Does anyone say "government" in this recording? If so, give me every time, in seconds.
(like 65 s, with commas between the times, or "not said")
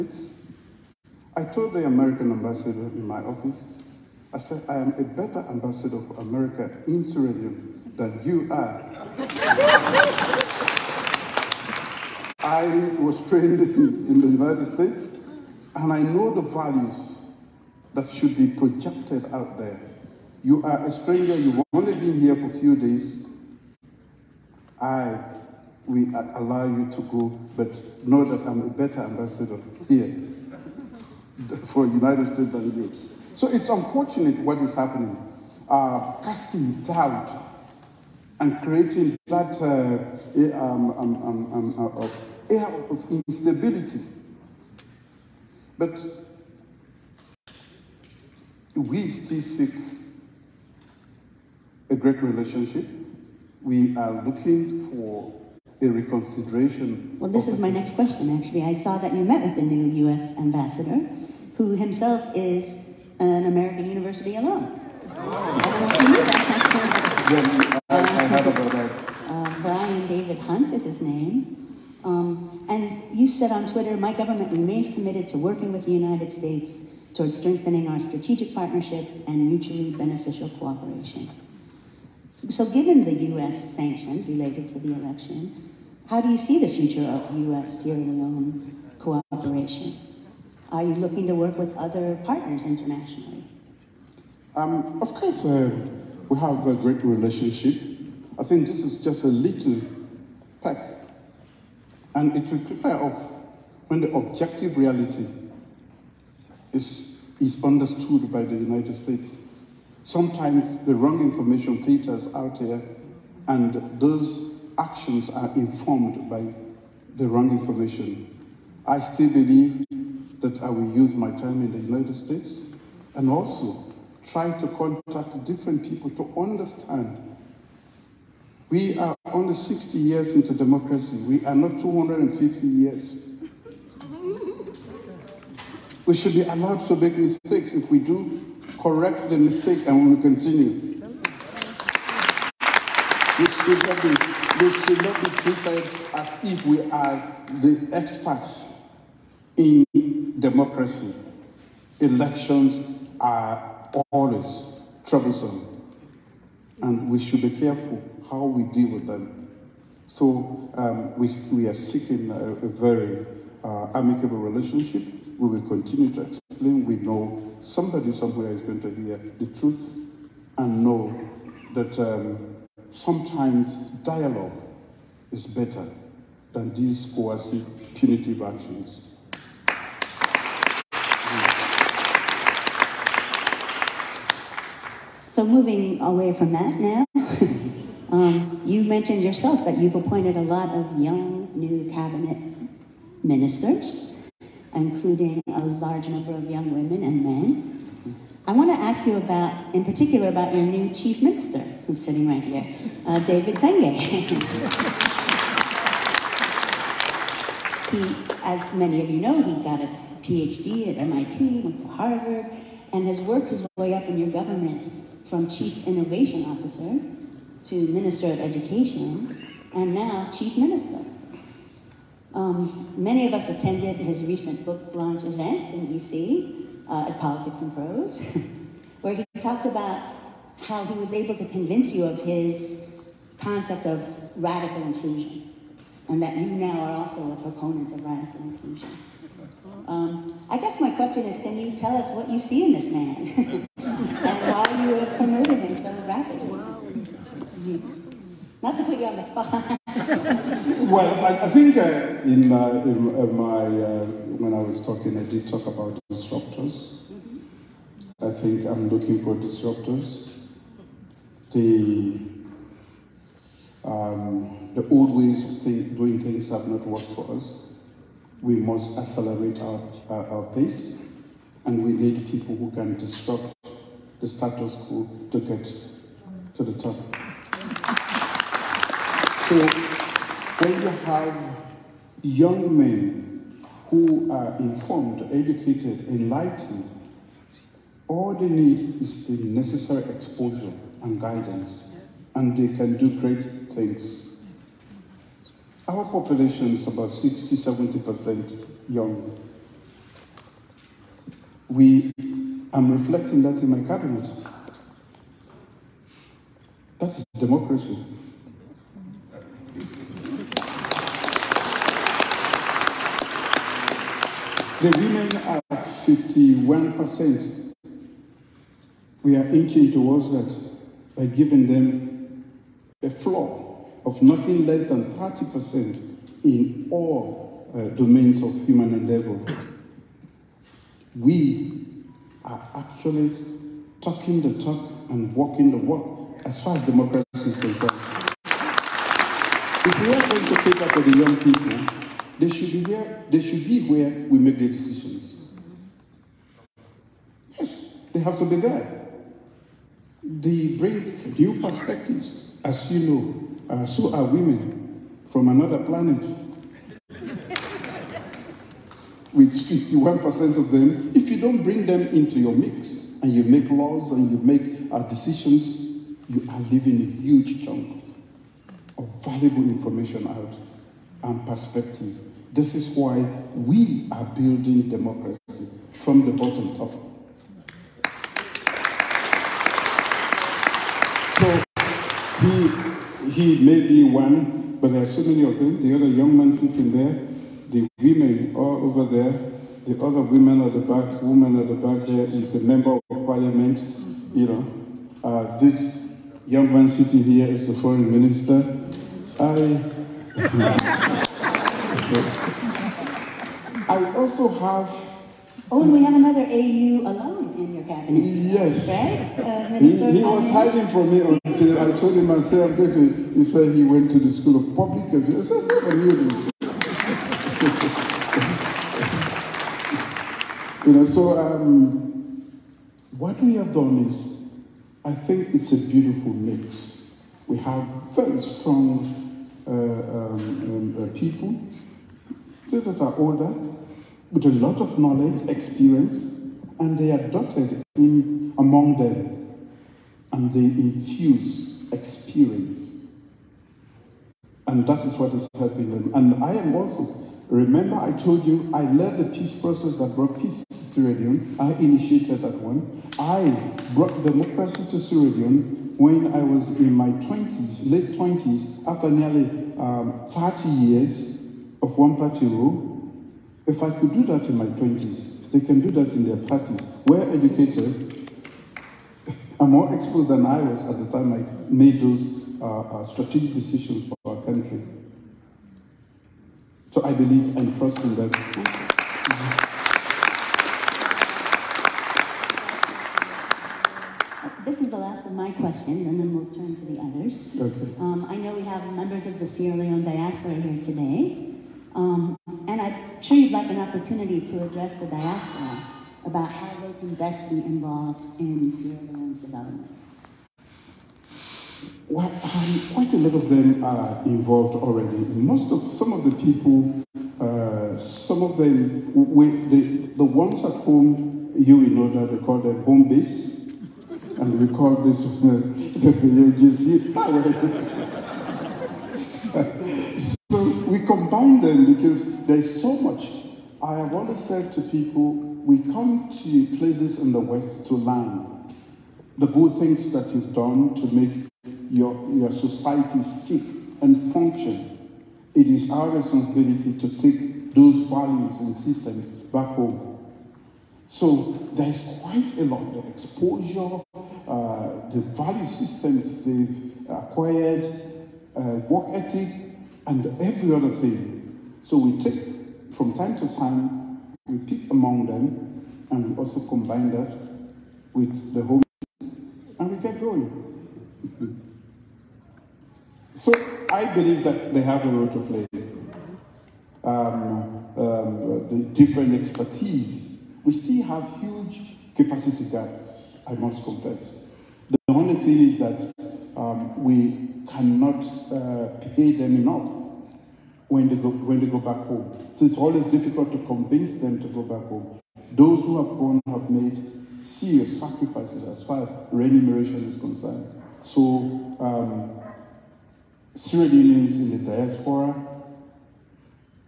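74 s, 214 s.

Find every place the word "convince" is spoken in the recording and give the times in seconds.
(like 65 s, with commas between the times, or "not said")
231 s, 583 s.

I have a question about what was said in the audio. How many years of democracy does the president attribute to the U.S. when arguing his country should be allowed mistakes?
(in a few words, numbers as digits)
250.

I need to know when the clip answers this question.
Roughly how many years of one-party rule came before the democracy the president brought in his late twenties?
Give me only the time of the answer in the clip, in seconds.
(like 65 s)
460 s.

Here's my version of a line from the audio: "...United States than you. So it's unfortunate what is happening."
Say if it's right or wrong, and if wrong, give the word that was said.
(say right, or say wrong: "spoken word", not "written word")
right.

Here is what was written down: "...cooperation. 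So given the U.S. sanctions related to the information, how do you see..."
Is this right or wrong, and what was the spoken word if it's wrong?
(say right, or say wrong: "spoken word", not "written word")
wrong: "election", not "information".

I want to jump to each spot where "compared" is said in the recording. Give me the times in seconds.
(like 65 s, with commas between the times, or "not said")
not said.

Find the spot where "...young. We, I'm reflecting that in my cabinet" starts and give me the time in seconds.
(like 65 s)
298 s.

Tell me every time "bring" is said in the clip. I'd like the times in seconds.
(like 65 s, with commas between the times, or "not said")
350 s, 361 s.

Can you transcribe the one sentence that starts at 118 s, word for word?
I still believe that I will use my time in the United States and also try to contact different people to understand.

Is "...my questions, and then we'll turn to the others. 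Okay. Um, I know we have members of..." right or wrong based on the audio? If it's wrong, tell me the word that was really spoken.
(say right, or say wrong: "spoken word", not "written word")
right.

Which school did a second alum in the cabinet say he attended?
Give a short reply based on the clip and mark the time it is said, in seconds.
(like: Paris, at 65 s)
School of Public Affairs, at 414 s.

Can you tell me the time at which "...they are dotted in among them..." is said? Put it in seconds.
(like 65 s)
436 s.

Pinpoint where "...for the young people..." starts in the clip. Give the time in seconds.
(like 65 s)
340 s.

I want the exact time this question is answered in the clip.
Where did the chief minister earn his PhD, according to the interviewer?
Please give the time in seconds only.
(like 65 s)
210 s.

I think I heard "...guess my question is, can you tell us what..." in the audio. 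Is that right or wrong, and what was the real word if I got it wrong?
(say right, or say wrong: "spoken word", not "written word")
right.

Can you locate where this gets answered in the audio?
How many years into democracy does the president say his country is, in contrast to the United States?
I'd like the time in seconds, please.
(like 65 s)
129 s.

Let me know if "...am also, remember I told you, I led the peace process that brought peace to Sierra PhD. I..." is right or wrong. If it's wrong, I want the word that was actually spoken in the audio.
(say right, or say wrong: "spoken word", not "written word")
wrong: "Leone", not "PhD".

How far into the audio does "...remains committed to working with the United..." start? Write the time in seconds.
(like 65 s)
74 s.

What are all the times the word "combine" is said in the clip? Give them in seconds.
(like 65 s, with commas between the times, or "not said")
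521 s, 556 s.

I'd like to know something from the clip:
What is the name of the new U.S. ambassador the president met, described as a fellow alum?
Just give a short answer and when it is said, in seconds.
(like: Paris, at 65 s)
Bryan David Hunt, at 69 s.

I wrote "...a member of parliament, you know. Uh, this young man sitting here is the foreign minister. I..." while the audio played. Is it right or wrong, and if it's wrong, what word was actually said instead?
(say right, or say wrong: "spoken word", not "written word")
right.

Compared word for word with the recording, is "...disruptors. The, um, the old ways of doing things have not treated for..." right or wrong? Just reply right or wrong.
wrong.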